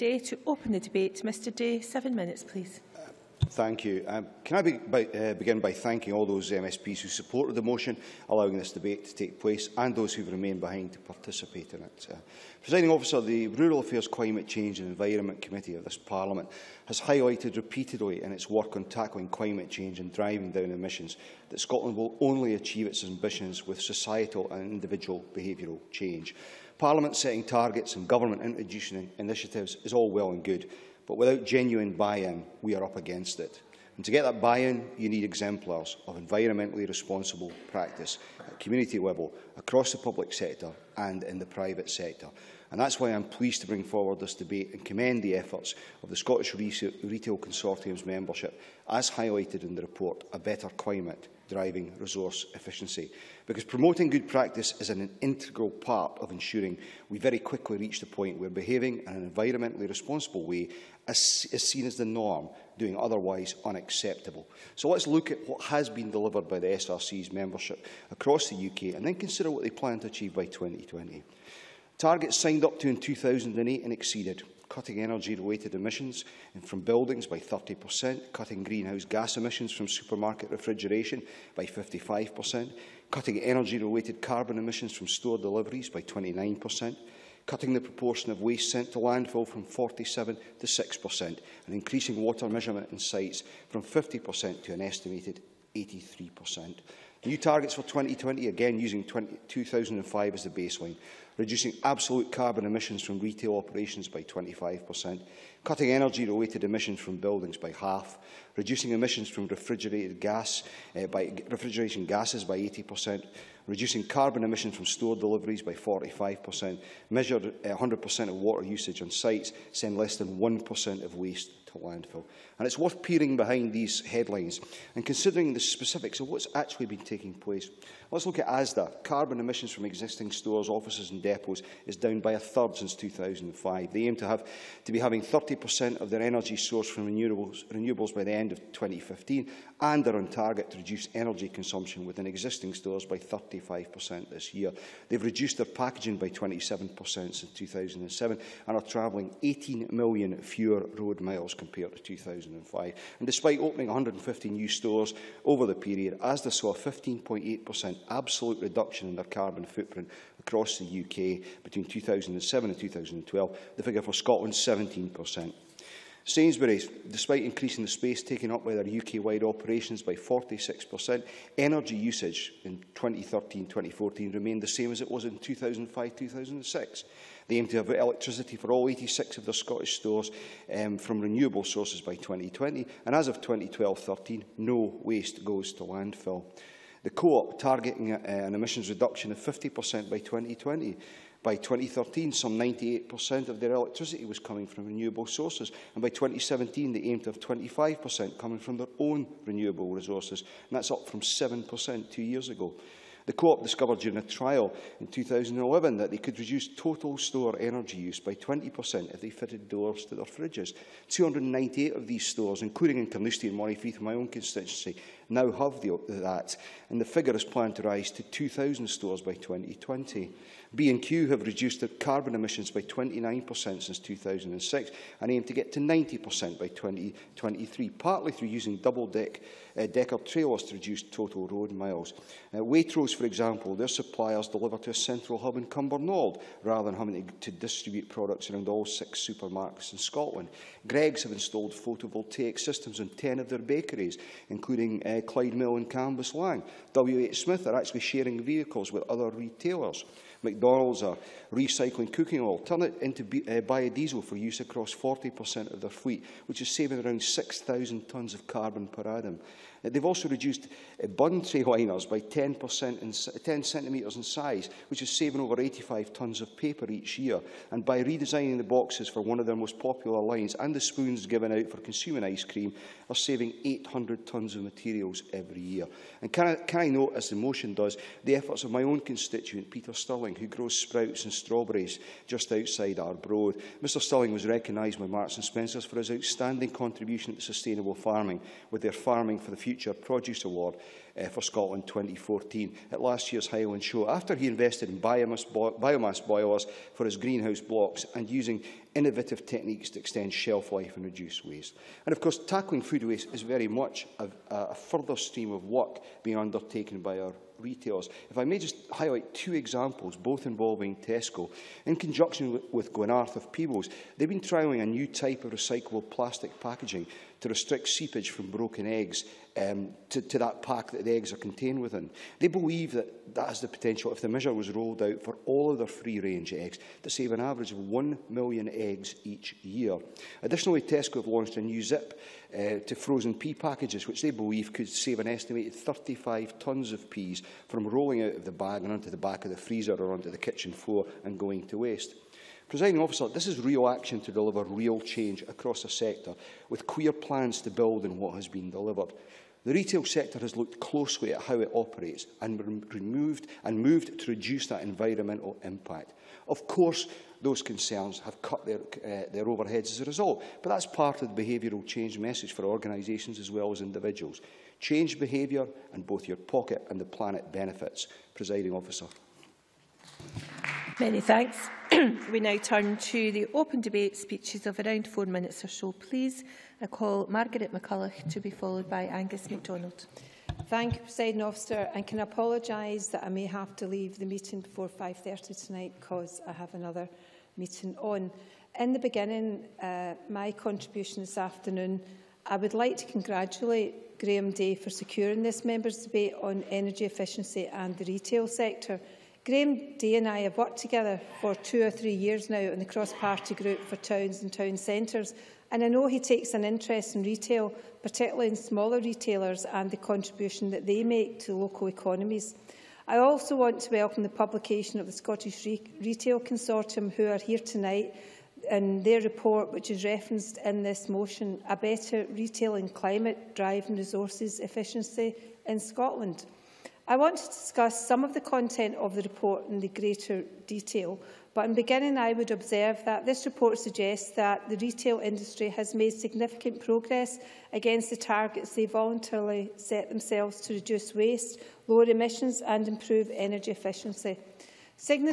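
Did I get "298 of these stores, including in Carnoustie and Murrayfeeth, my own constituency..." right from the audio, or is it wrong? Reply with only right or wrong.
right.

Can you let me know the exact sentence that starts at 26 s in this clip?
Parliament setting targets and government introducing initiatives is all well and good, but without genuine buy-in, we are up against it.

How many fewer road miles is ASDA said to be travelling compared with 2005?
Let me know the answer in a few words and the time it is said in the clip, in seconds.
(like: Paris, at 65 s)
18 million, at 149 s.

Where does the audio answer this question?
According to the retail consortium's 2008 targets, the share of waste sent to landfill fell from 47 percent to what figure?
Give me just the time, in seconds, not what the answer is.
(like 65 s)
90 s.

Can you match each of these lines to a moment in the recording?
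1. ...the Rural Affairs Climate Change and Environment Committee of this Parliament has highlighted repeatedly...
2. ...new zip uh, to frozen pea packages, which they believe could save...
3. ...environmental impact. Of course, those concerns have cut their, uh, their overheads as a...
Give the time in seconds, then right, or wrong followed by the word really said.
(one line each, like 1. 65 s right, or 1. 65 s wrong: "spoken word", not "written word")
1. 13 s right
2. 331 s right
3. 354 s right.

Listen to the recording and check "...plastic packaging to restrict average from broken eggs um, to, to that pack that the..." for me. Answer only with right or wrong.
wrong.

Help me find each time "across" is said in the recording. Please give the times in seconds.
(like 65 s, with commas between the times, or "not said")
39 s, 68 s, 160 s, 254 s, 345 s.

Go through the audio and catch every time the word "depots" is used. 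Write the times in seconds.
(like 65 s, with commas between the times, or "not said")
131 s.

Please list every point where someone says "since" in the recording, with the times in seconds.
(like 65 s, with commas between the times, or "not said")
132 s, 147 s, 223 s.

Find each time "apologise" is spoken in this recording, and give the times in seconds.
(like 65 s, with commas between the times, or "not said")
382 s.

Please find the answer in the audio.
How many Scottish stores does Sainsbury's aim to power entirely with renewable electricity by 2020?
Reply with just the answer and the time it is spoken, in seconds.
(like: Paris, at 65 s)
86, at 178 s.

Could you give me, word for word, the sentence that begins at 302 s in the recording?
And of course, tackling food waste is very much a, a further stream of work being undertaken by our retailers.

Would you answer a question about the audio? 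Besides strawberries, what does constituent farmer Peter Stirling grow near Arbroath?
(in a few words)
Sprouts.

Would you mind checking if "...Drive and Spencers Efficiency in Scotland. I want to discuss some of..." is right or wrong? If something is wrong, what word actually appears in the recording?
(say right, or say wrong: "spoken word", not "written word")
wrong: "Resources", not "Spencers".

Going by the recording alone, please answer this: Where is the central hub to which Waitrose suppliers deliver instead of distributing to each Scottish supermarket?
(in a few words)
Cumbernauld.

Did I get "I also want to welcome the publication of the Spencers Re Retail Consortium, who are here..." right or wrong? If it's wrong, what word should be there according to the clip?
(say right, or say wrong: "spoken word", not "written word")
wrong: "Scottish", not "Spencers".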